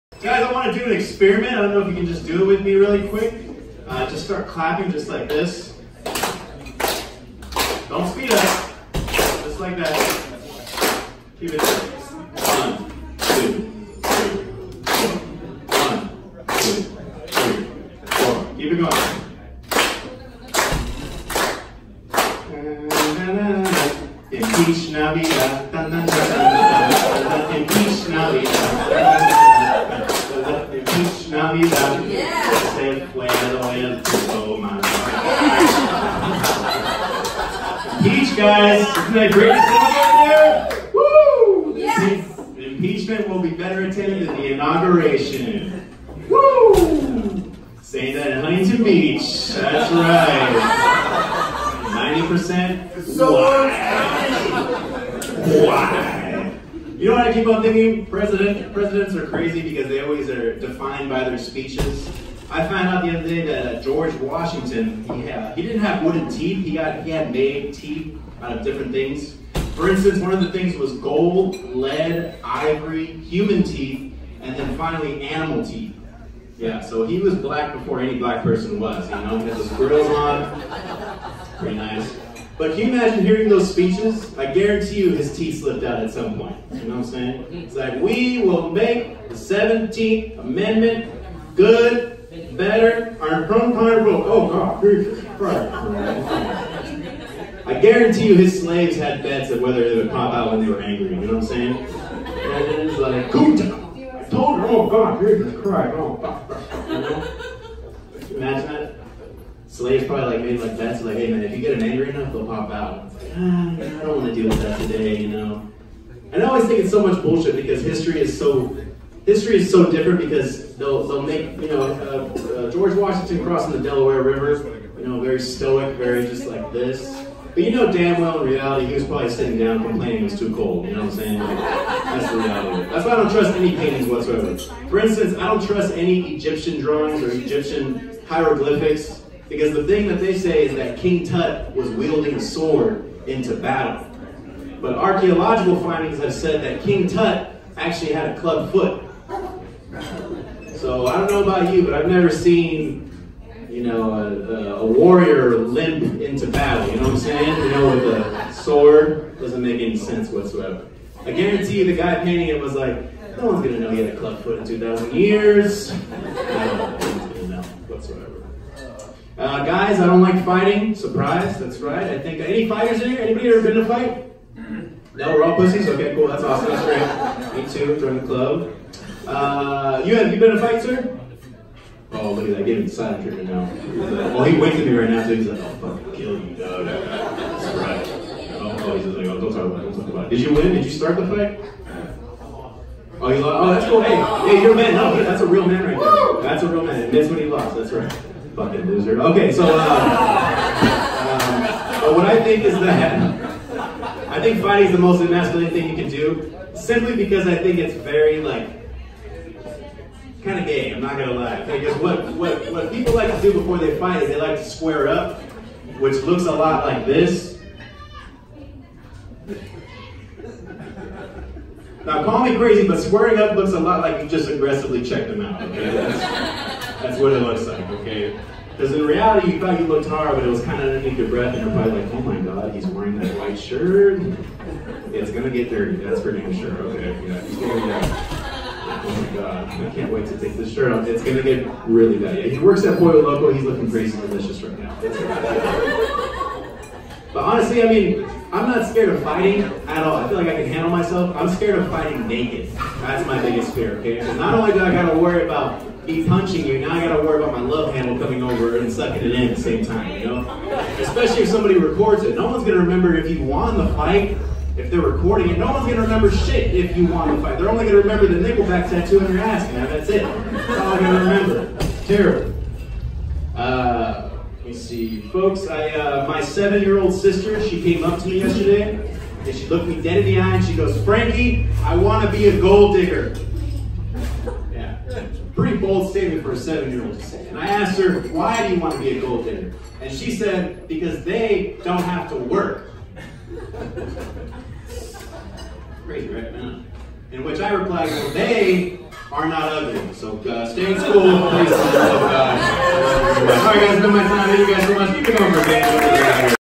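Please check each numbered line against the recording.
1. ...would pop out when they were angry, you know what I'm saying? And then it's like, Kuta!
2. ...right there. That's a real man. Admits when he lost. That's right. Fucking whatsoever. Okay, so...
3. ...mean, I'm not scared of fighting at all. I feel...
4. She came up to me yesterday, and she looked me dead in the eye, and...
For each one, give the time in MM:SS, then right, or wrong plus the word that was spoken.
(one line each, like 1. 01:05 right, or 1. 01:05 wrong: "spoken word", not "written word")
1. 01:39 right
2. 03:15 wrong: "loser", not "whatsoever"
3. 04:07 right
4. 04:37 right.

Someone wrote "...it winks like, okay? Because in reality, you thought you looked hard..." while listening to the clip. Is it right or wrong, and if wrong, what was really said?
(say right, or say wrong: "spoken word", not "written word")
wrong: "looks", not "winks".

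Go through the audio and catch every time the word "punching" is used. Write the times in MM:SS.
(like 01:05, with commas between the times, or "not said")
04:16.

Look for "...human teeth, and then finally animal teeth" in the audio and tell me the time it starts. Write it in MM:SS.
01:13.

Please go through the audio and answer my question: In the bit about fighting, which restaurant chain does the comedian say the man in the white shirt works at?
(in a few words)
Pollo Loco.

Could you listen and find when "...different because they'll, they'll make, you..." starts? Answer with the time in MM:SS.
01:59.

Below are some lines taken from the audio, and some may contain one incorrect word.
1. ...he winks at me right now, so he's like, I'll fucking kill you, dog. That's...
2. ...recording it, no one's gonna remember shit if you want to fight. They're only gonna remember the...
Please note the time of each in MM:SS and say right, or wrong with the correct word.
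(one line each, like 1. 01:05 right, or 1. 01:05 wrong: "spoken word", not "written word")
1. 03:04 right
2. 04:25 right.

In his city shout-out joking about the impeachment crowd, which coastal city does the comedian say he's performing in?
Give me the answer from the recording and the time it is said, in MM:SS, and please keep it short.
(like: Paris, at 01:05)
Huntington Beach, at 00:48.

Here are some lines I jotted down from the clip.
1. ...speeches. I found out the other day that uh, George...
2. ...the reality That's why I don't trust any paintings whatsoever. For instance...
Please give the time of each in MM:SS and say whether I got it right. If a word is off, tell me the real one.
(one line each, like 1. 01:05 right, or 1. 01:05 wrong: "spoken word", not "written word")
1. 01:01 right
2. 02:12 right.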